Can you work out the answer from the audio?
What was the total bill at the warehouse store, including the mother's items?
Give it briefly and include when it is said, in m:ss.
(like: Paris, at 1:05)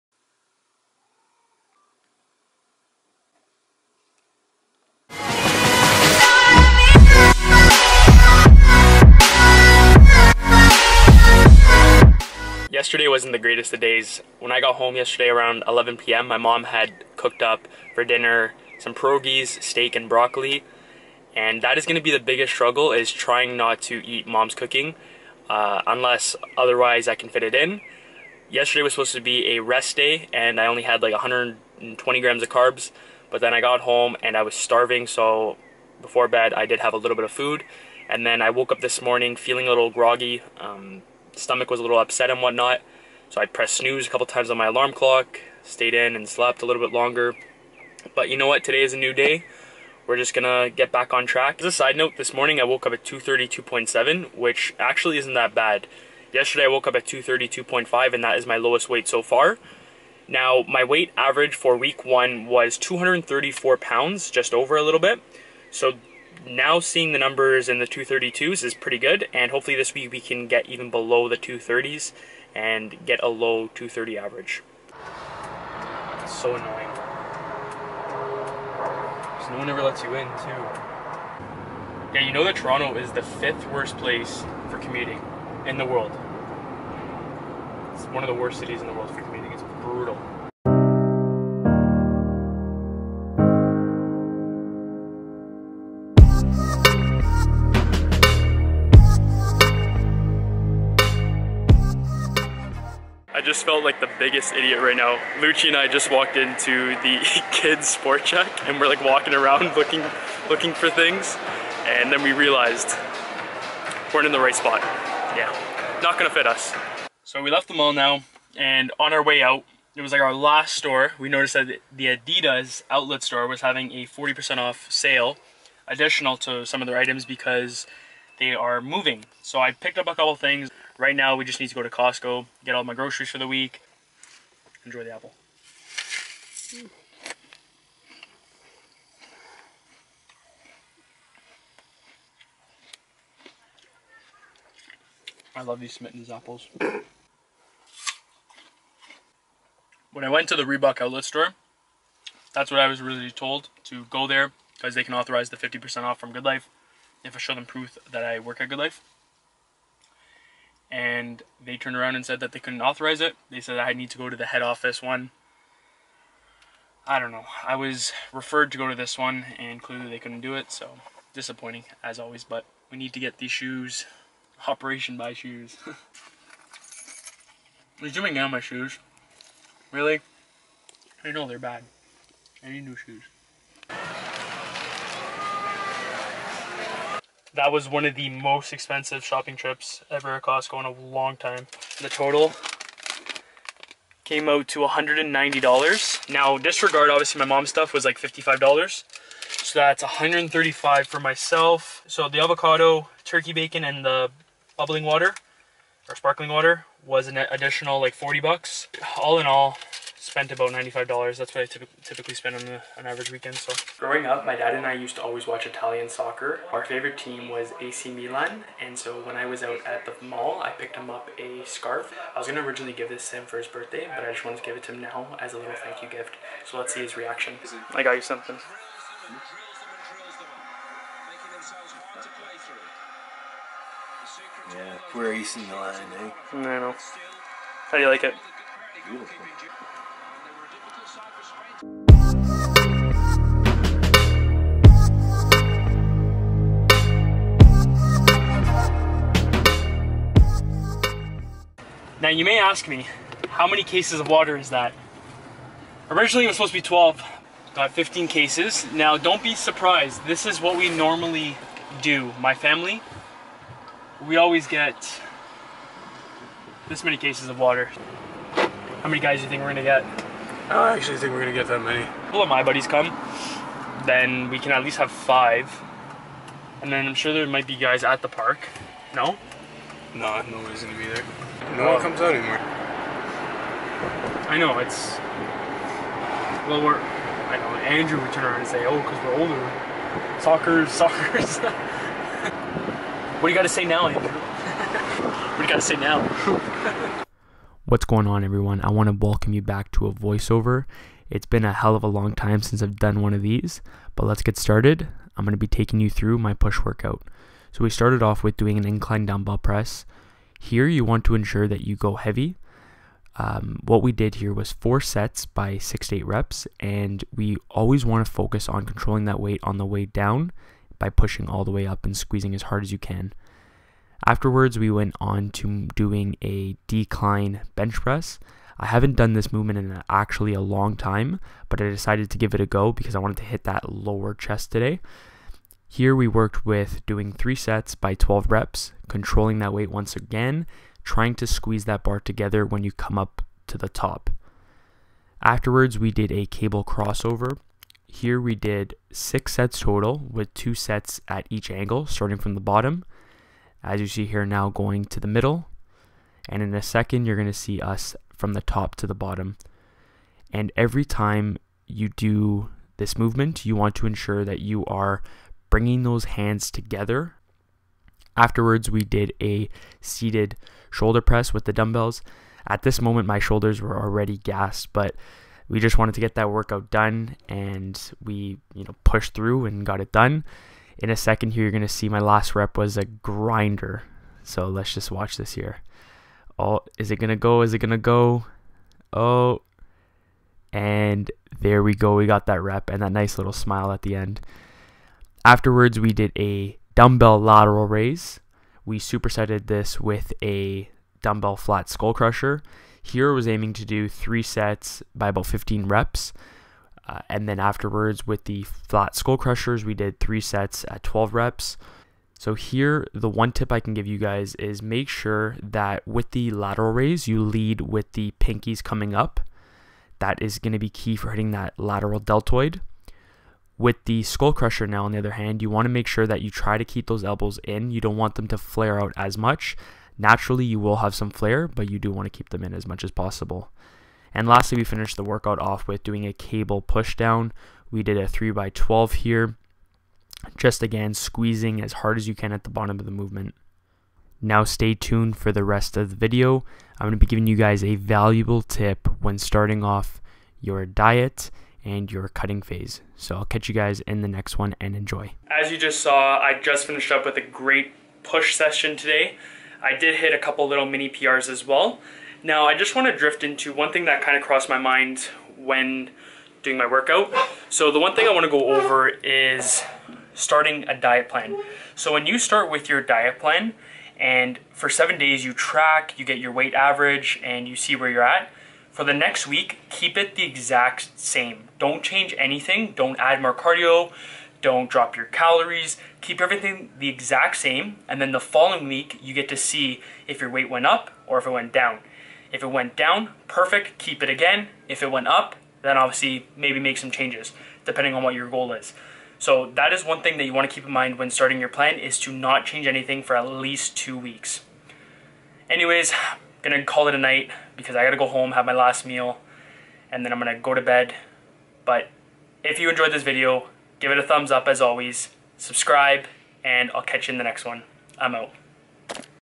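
$190, at 3:14.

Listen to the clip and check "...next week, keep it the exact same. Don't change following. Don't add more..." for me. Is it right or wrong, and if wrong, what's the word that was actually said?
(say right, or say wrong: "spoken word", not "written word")
wrong: "anything", not "following".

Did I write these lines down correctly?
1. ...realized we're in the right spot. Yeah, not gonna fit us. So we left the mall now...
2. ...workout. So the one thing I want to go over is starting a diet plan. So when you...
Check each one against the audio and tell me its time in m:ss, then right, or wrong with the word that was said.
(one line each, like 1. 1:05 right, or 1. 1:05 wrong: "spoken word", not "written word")
1. 1:52 right
2. 7:46 right.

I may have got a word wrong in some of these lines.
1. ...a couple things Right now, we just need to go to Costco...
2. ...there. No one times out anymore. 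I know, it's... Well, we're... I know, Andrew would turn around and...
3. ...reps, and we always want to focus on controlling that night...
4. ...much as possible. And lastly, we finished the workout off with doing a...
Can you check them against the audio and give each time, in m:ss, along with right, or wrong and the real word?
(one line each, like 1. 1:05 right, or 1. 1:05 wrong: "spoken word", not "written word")
1. 2:10 right
2. 4:41 wrong: "comes", not "times"
3. 5:16 wrong: "weight", not "night"
4. 7:12 right.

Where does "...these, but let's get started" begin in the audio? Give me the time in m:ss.
5:03.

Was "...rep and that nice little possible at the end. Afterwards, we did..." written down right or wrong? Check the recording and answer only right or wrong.
wrong.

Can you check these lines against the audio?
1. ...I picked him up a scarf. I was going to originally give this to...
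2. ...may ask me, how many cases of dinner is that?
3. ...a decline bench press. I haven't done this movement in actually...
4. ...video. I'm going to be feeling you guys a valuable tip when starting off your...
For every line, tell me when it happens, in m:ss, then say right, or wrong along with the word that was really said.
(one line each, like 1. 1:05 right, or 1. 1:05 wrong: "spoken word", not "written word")
1. 3:40 right
2. 4:12 wrong: "water", not "dinner"
3. 5:26 right
4. 7:26 wrong: "giving", not "feeling".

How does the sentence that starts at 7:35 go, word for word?
As you just saw, I just finished up with a great push session today.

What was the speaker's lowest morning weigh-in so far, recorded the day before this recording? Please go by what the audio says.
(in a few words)
232.5.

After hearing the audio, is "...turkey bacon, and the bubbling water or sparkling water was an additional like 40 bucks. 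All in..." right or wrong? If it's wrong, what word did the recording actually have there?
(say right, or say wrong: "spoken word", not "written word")
right.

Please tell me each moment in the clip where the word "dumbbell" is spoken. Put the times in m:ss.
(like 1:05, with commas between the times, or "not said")
5:09, 6:11, 6:36, 6:41.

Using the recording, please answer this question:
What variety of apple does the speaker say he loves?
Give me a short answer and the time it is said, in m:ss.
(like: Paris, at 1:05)
Smitten's, at 2:25.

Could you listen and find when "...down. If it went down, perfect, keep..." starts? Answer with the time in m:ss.
8:11.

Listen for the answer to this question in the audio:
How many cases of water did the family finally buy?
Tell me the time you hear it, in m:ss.
4:17.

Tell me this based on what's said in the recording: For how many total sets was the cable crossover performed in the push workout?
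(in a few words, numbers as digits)
6.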